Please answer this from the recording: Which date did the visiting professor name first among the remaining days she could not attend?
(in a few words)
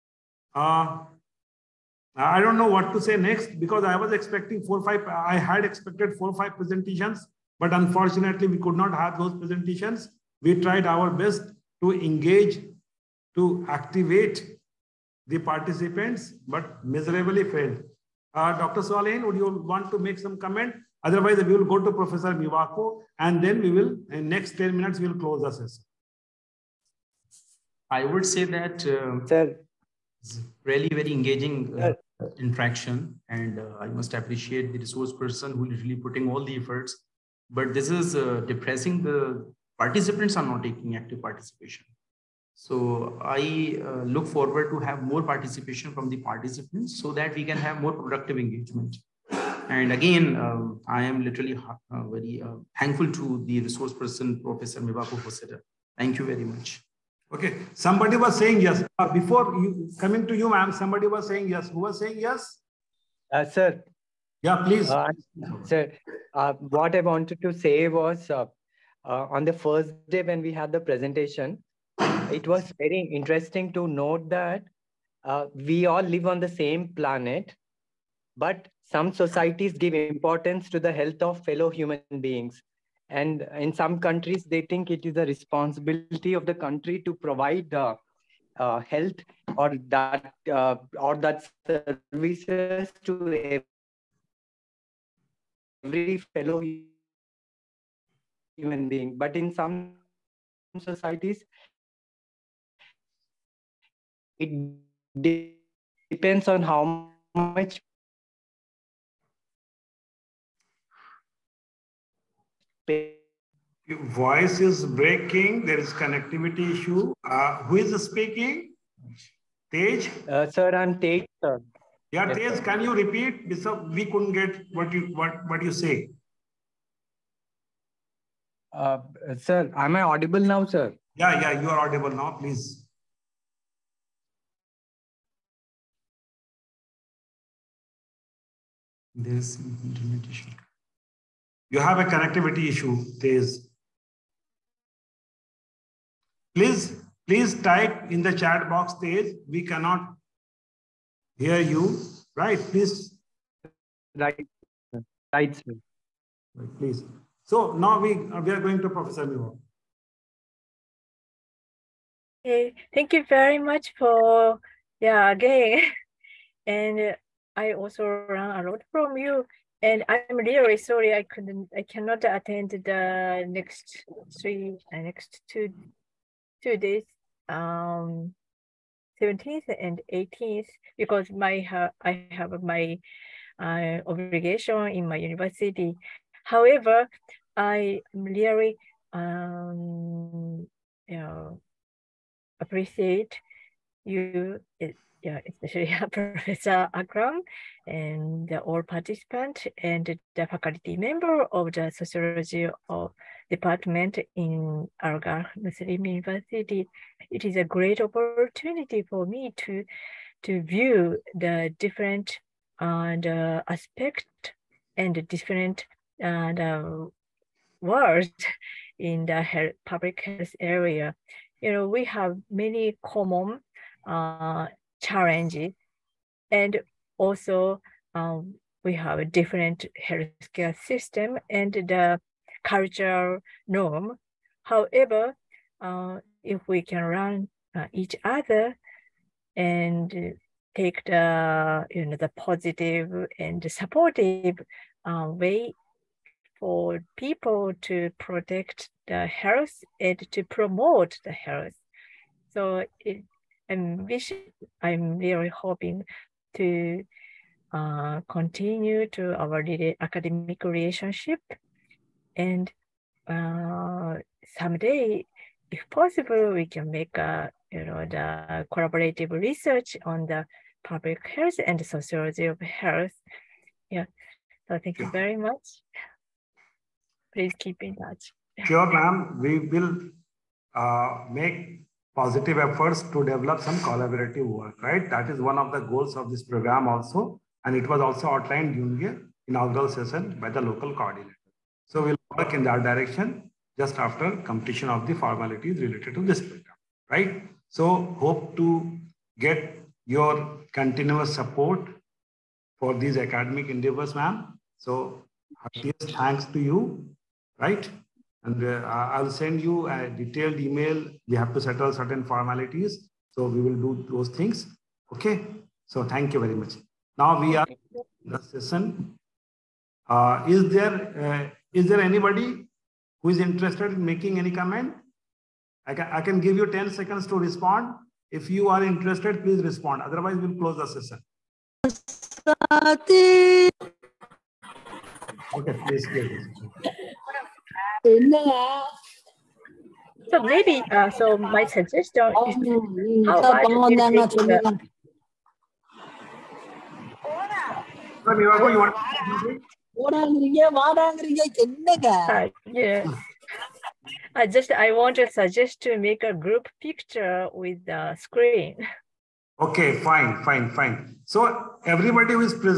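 17th.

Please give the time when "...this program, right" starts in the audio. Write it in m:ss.
4:56.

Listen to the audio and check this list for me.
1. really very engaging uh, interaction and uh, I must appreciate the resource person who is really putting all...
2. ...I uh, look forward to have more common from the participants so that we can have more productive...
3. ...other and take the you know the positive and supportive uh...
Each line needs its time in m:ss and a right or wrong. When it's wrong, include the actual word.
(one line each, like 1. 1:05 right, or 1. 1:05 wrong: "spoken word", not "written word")
1. 0:30 right
2. 0:43 wrong: "participation", not "common"
3. 3:58 right.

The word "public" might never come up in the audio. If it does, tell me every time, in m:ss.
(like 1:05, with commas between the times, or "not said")
3:39, 4:30.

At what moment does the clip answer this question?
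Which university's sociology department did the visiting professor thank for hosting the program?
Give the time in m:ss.
3:25.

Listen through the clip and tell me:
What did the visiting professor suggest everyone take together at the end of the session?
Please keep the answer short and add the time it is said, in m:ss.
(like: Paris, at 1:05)
group picture, at 5:56.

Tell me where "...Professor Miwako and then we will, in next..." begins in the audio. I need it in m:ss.
0:21.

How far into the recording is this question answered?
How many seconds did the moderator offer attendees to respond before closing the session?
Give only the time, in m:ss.
5:26.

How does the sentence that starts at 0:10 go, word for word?
We tried our best to engage, to activate the participants, but miserably failed.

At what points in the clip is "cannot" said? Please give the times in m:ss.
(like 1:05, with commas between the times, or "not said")
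2:29, 2:51.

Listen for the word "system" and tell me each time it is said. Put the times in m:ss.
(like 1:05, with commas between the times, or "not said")
3:50.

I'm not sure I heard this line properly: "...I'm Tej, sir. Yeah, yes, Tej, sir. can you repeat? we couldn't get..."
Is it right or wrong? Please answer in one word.
right.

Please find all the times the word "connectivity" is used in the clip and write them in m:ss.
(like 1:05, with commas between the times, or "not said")
1:56, 2:22.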